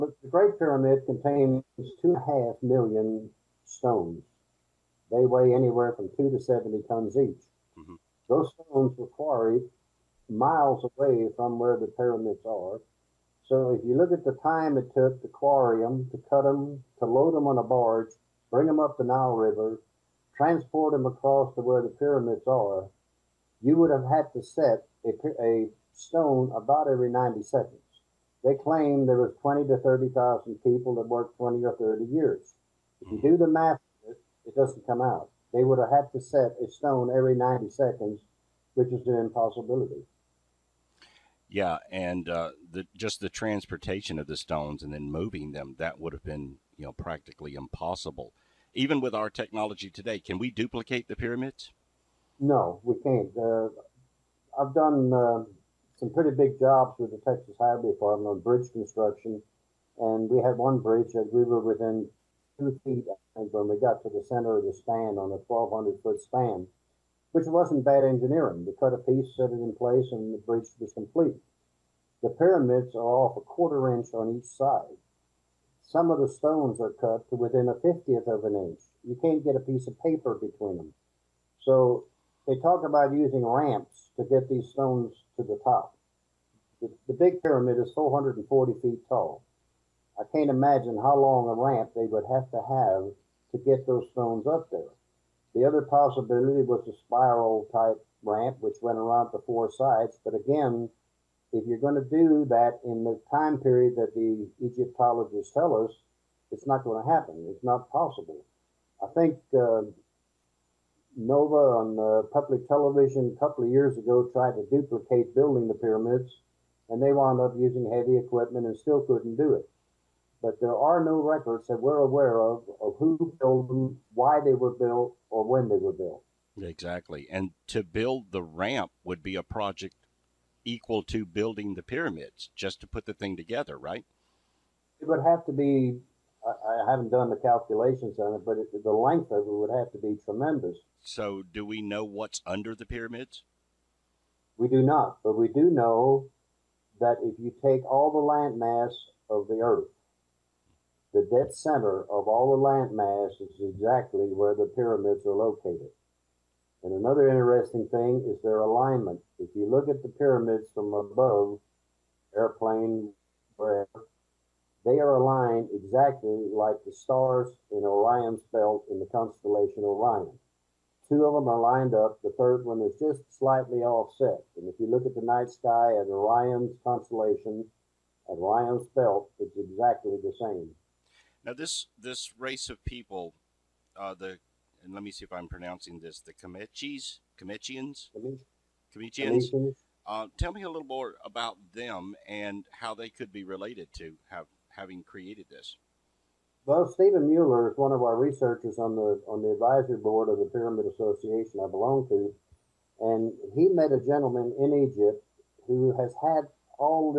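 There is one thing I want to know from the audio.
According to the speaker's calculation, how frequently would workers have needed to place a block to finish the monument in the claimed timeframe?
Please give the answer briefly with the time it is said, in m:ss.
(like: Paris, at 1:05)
every 90 seconds, at 0:26.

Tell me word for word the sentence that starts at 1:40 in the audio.
But again, if you're going to do that in the time period that the Egyptologists tell us, it's not going to happen.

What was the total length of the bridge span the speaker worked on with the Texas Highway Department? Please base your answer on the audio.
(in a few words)
1,200 feet.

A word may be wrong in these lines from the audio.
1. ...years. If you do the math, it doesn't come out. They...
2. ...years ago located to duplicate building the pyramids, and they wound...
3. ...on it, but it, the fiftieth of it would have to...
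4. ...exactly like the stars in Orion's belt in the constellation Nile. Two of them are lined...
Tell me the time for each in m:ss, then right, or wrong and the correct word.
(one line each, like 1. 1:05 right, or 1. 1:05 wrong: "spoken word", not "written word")
1. 0:32 right
2. 1:53 wrong: "tried", not "located"
3. 2:18 wrong: "length", not "fiftieth"
4. 2:45 wrong: "Orion", not "Nile".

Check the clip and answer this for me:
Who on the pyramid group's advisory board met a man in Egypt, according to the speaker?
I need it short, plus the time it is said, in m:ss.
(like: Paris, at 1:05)
Stephen Mehler, at 3:16.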